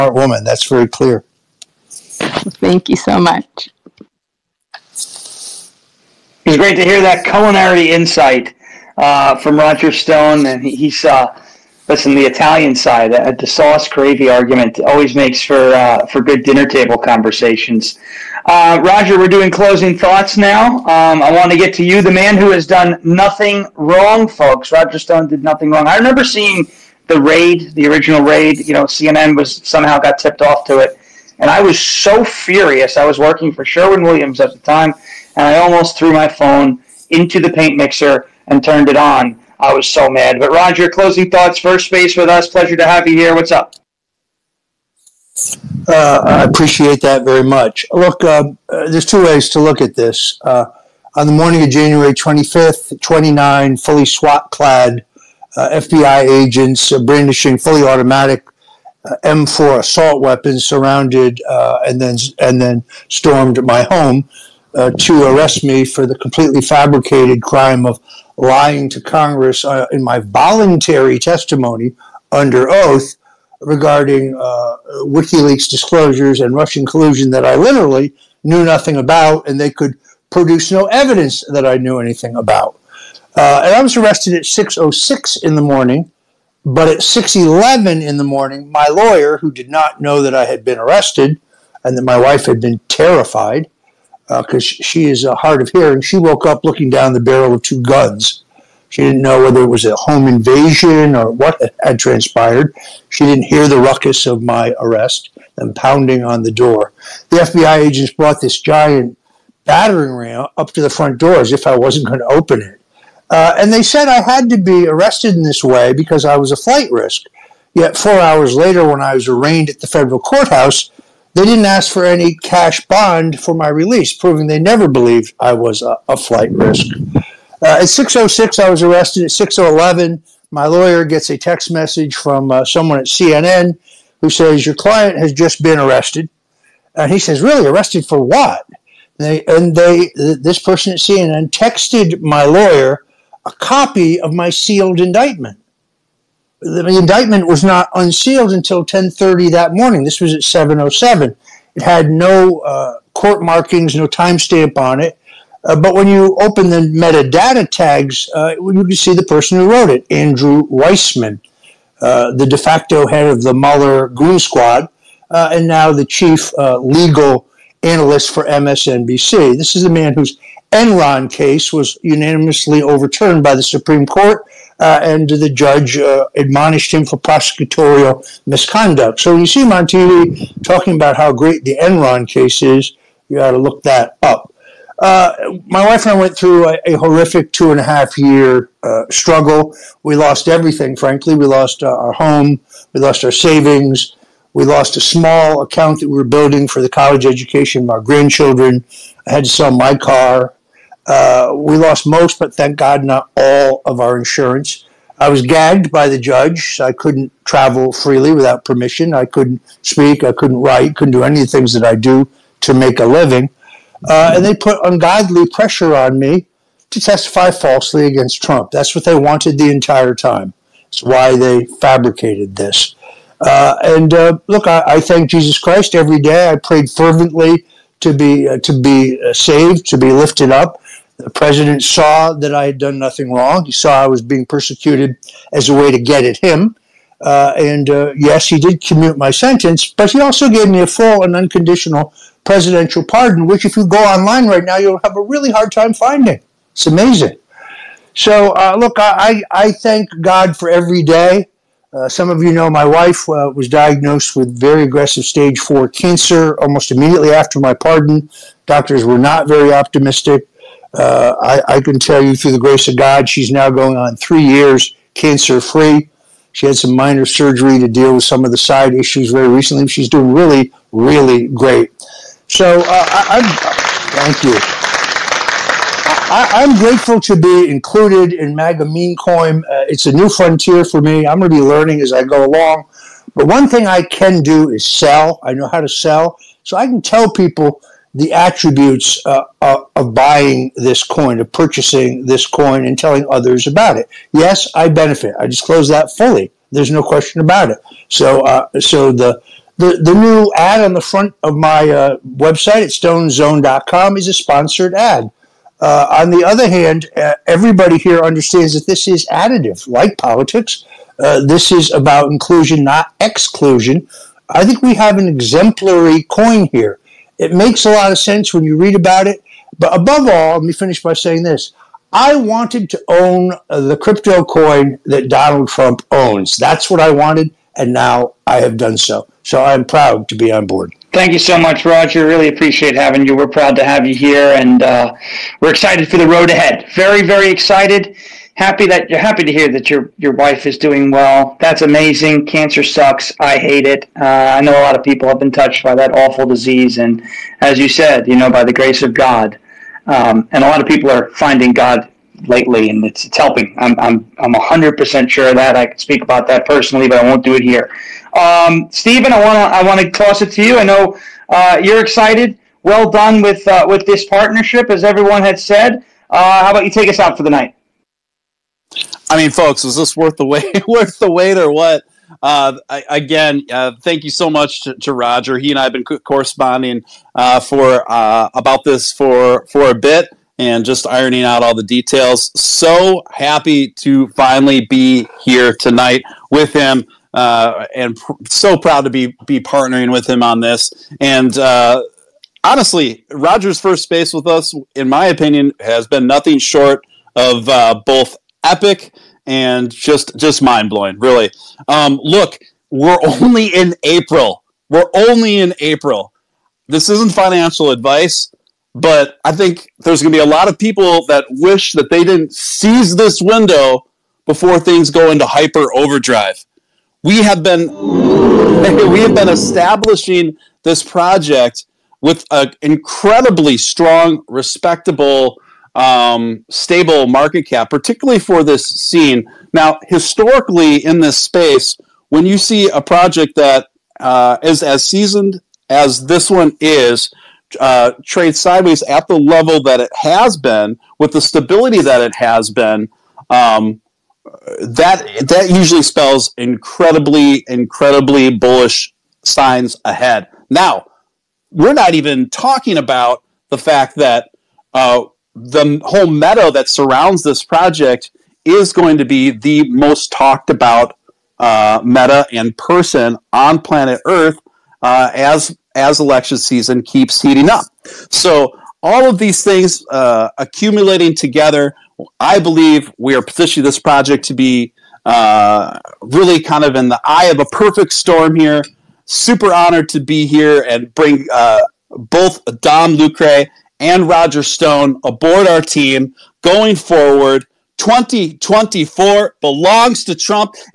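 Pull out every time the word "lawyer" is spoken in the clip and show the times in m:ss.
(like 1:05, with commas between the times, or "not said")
1:28, 2:10, 2:22.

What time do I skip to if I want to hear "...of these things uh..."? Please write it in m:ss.
7:49.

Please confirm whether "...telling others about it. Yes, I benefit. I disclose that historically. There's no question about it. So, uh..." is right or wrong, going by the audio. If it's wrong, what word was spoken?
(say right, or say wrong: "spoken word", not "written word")
wrong: "fully", not "historically".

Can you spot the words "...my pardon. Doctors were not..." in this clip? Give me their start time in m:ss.
4:17.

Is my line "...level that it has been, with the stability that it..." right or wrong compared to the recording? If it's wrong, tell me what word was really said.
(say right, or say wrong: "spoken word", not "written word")
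right.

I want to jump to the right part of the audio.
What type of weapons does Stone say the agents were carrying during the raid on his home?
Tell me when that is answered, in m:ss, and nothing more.
0:59.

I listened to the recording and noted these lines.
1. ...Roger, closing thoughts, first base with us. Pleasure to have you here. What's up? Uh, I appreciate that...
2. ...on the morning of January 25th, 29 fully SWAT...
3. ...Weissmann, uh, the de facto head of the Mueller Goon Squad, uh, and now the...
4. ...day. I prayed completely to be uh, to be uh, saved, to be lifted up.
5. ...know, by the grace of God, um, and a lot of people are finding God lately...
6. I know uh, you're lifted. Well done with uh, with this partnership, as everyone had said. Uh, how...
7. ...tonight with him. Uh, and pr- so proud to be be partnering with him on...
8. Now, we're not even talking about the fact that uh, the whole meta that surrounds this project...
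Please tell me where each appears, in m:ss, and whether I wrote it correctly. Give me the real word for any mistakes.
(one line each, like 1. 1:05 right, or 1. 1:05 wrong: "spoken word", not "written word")
1. 0:40 right
2. 0:51 right
3. 2:40 right
4. 3:46 wrong: "fervently", not "completely"
5. 5:48 right
6. 6:00 wrong: "excited", not "lifted"
7. 6:25 right
8. 7:30 right.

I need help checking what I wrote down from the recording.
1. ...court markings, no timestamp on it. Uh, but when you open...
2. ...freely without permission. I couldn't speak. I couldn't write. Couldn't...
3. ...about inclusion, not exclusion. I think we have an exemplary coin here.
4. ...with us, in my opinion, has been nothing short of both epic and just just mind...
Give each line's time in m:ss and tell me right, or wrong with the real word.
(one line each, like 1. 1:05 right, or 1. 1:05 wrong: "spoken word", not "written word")
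1. 2:33 right
2. 3:27 right
3. 5:11 right
4. 6:34 right.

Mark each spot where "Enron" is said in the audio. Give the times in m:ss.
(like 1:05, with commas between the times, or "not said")
2:50, 3:01.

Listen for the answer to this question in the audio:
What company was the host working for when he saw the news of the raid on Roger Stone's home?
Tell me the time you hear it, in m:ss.
0:33.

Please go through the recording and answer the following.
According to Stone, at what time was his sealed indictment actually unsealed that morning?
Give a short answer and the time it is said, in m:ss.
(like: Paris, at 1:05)
10:30, at 2:28.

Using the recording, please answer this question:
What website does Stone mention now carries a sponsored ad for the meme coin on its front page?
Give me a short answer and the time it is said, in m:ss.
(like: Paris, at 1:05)
stonezone.com, at 5:02.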